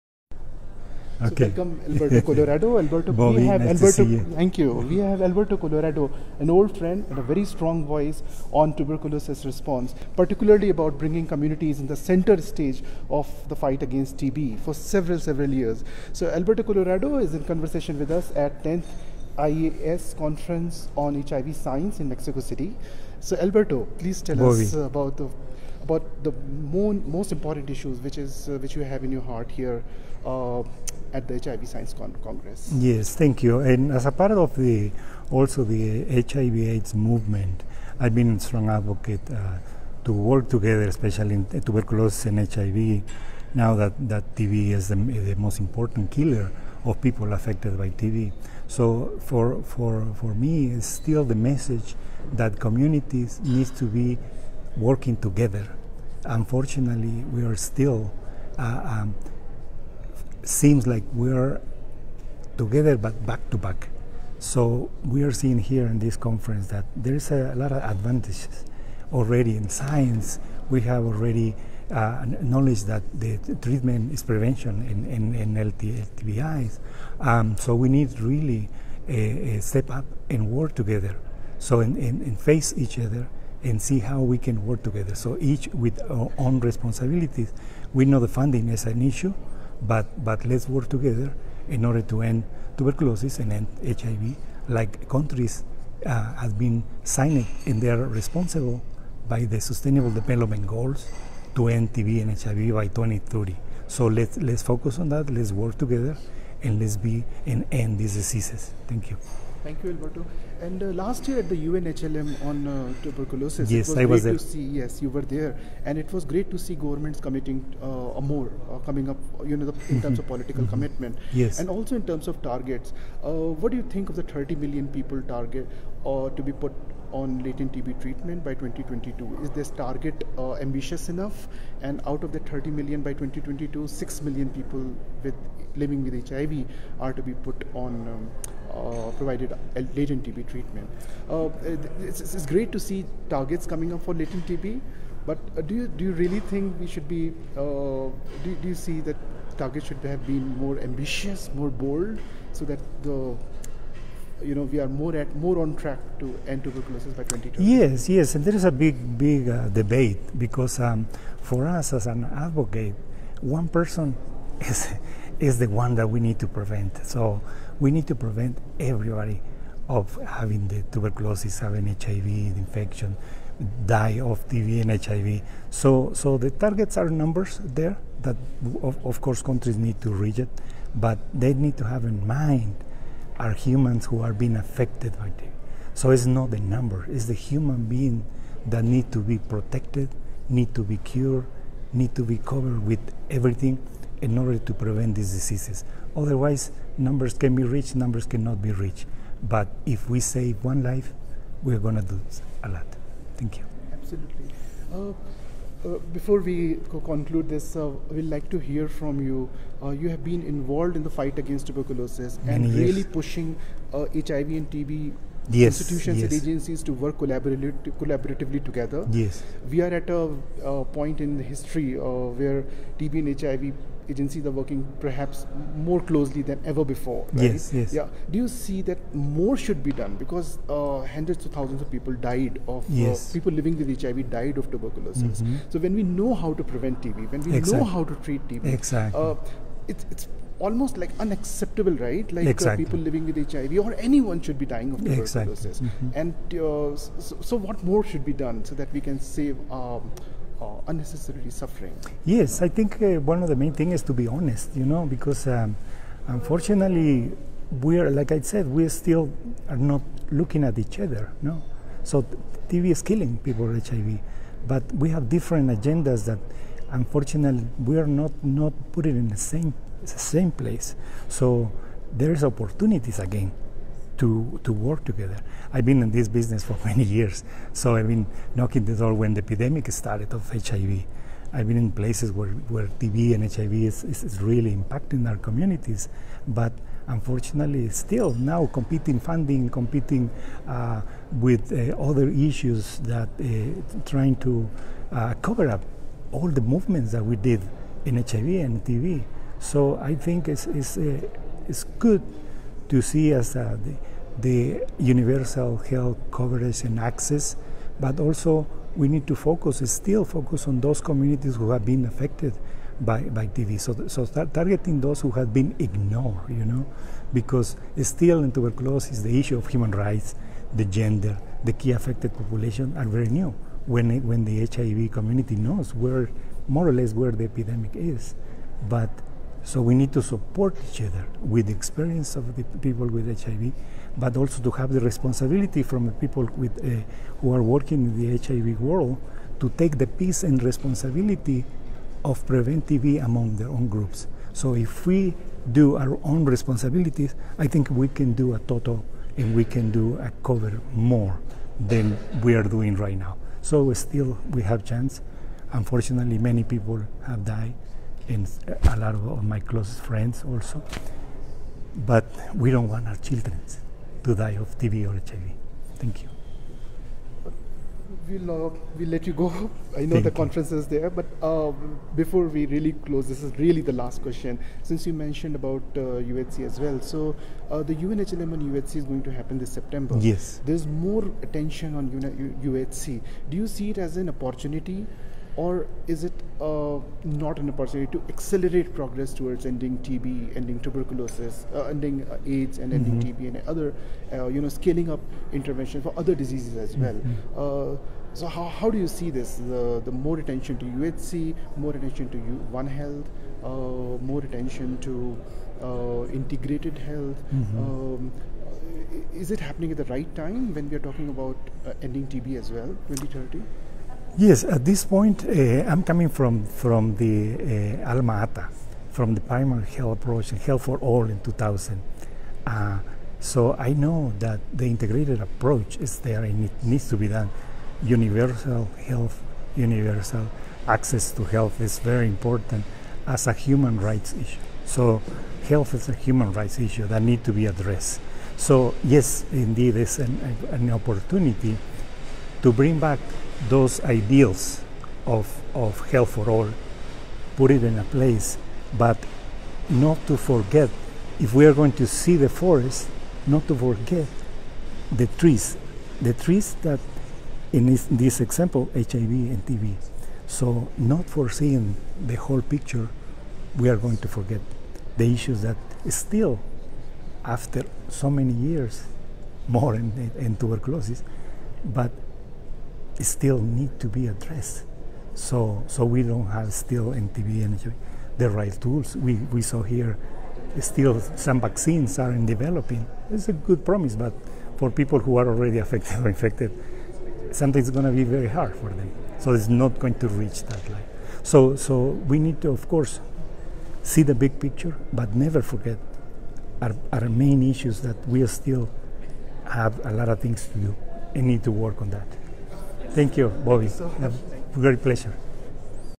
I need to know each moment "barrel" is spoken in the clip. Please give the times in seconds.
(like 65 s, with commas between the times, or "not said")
not said.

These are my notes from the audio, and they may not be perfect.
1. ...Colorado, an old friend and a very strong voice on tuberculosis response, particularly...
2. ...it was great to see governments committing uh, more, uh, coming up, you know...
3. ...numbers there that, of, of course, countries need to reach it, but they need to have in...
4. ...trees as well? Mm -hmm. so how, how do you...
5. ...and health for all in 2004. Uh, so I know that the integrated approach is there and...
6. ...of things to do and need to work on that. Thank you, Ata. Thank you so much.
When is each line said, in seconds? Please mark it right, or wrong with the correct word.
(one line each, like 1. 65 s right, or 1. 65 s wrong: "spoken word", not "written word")
1. 5 s right
2. 115 s right
3. 177 s right
4. 396 s wrong: "diseases", not "trees"
5. 420 s wrong: "2000", not "2004"
6. 500 s wrong: "Bobby", not "Ata".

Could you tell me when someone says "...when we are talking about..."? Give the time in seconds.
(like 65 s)
410 s.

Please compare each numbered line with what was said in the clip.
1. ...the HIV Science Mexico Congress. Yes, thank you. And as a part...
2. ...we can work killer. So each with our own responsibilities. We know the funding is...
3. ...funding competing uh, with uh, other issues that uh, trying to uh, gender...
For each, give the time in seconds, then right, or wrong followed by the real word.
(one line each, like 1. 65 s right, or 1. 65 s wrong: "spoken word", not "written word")
1. 31 s wrong: "Con", not "Mexico"
2. 84 s wrong: "together", not "killer"
3. 289 s wrong: "cover", not "gender".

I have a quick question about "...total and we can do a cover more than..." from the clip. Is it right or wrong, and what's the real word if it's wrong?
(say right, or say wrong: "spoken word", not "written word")
right.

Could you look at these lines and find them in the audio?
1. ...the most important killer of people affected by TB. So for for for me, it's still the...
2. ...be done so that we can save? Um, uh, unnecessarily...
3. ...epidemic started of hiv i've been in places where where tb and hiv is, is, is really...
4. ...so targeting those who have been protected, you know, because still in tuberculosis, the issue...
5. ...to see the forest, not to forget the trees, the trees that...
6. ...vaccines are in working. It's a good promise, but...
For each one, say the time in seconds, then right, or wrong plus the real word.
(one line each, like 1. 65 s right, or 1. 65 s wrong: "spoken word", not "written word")
1. 44 s right
2. 248 s right
3. 279 s right
4. 314 s wrong: "ignored", not "protected"
5. 451 s right
6. 481 s wrong: "developing", not "working".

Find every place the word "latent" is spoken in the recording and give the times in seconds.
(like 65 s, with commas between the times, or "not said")
127 s, 139 s, 144 s.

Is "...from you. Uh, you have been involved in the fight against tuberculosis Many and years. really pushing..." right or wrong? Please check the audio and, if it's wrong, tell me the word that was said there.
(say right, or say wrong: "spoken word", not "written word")
right.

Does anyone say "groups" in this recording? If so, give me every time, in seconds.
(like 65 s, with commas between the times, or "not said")
343 s.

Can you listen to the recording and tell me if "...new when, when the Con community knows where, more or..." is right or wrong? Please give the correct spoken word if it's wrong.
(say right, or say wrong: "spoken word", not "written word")
wrong: "HIV", not "Con".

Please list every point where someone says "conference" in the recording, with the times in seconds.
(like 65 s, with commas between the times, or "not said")
20 s, 66 s, 370 s.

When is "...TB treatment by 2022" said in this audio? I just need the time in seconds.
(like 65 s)
127 s.